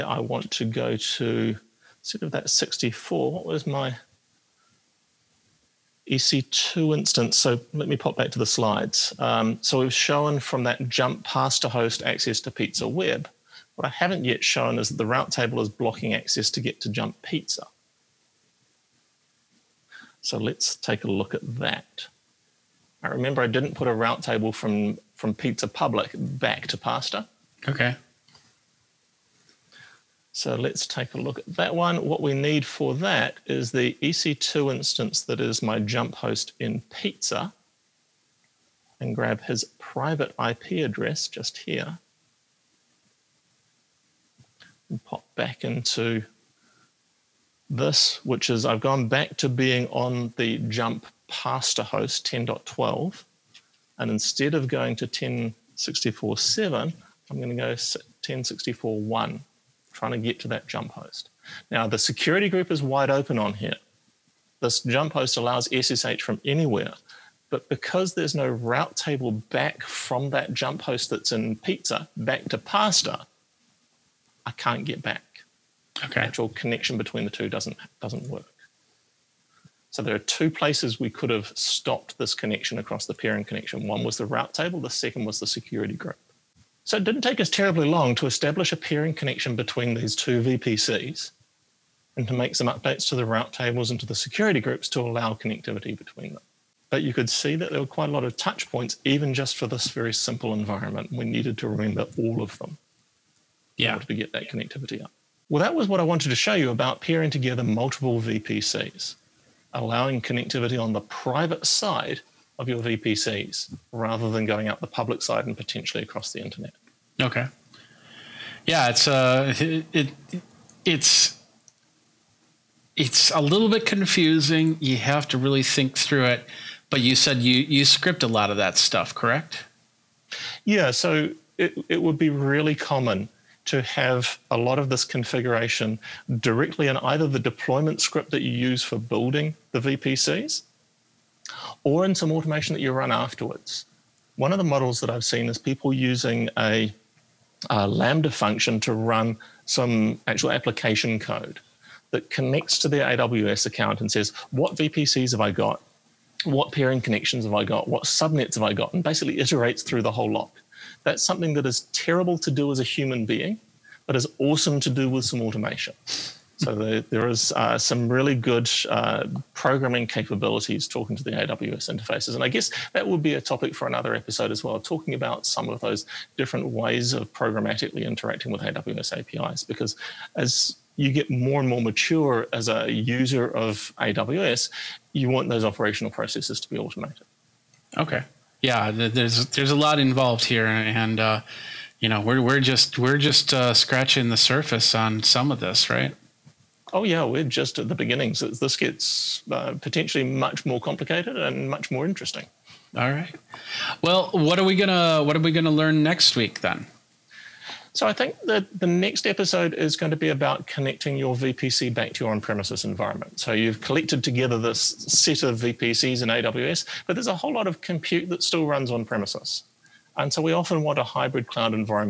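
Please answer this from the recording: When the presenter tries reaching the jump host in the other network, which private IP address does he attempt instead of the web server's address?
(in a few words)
10.64.1.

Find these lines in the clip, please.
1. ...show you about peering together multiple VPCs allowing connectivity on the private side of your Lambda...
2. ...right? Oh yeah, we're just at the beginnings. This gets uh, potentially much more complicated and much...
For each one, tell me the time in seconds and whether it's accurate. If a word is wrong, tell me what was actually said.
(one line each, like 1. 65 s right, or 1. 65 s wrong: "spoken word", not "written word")
1. 106 s wrong: "VPCs", not "Lambda"
2. 195 s right.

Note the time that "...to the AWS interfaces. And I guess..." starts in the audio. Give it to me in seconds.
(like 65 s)
171 s.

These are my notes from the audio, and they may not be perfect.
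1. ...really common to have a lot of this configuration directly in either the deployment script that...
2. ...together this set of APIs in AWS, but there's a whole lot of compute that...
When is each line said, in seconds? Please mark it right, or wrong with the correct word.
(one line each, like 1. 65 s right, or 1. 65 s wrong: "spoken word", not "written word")
1. 132 s right
2. 214 s wrong: "VPCs", not "APIs".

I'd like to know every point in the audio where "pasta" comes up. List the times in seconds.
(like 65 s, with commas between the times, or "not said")
11 s, 26 s, 51 s, 72 s.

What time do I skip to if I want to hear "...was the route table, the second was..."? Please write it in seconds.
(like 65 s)
84 s.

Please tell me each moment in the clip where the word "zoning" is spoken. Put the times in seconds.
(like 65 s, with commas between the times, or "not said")
not said.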